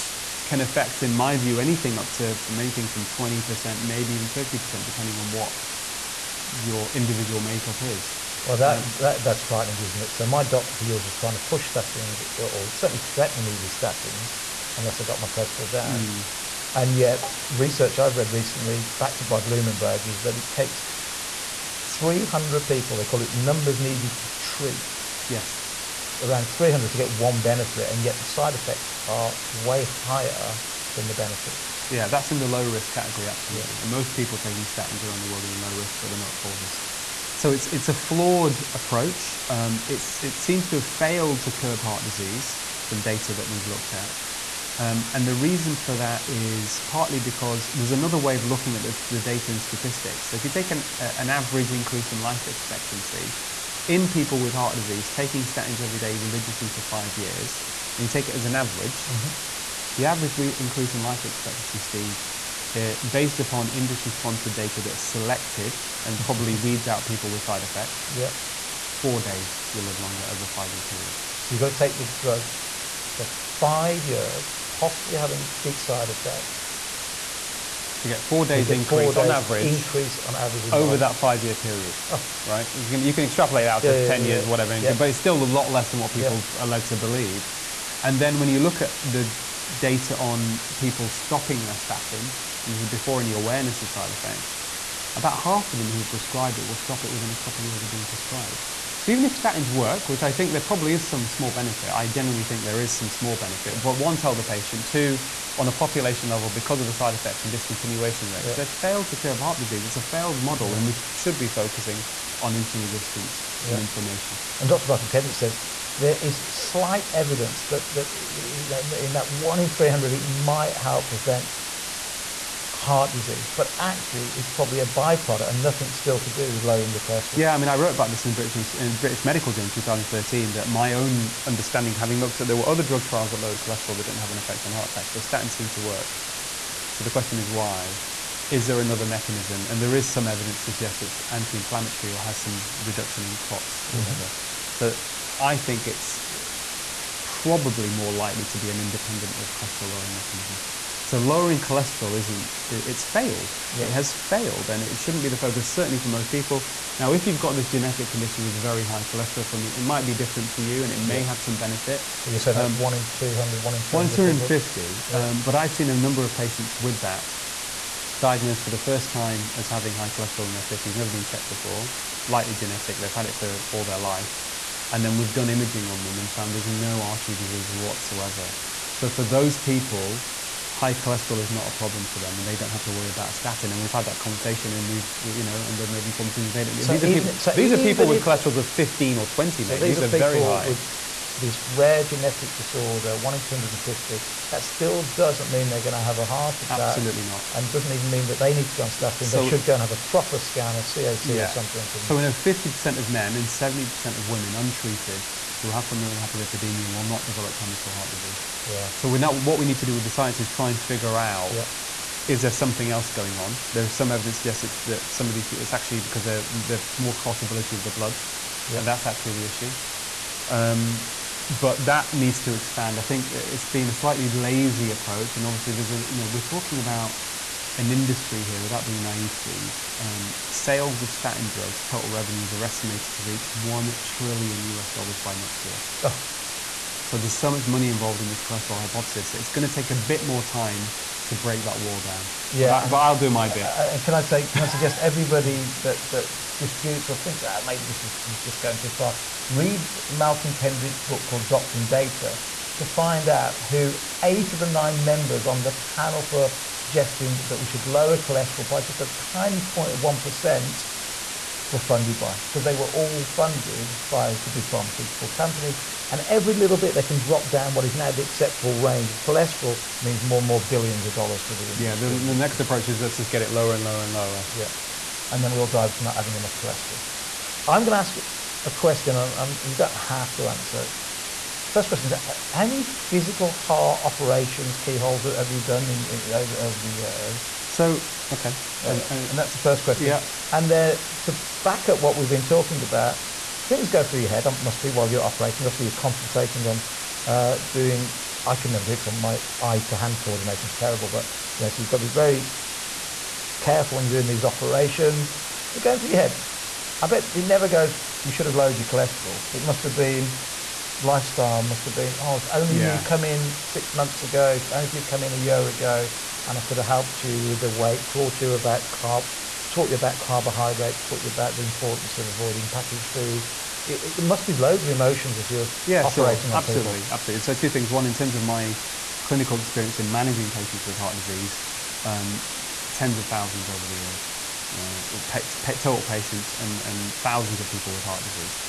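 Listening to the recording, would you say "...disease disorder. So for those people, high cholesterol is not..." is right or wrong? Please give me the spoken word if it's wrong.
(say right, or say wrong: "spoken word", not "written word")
wrong: "whatsoever", not "disorder".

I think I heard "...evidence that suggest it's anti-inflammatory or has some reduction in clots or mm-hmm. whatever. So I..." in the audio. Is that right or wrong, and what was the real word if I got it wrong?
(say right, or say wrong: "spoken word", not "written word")
right.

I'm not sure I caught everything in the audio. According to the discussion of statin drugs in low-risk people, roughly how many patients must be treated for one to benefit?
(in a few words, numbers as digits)
300.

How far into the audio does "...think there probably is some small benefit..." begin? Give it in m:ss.
1:40.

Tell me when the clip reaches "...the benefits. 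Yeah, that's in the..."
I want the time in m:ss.
0:31.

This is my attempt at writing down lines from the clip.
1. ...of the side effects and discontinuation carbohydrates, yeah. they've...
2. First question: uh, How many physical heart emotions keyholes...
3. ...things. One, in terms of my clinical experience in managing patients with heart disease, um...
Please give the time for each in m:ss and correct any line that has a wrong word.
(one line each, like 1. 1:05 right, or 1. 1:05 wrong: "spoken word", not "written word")
1. 1:46 wrong: "rates", not "carbohydrates"
2. 4:41 wrong: "operations", not "emotions"
3. 5:27 right.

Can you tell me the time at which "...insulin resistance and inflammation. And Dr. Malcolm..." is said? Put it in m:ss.
1:52.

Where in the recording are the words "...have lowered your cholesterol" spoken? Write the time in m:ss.
5:08.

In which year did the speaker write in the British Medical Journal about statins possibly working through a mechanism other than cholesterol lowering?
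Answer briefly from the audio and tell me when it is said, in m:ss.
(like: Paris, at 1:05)
2013, at 2:09.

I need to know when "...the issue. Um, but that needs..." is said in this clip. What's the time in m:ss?
3:39.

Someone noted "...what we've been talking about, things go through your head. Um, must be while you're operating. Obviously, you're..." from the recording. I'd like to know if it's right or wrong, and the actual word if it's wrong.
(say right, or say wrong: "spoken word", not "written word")
right.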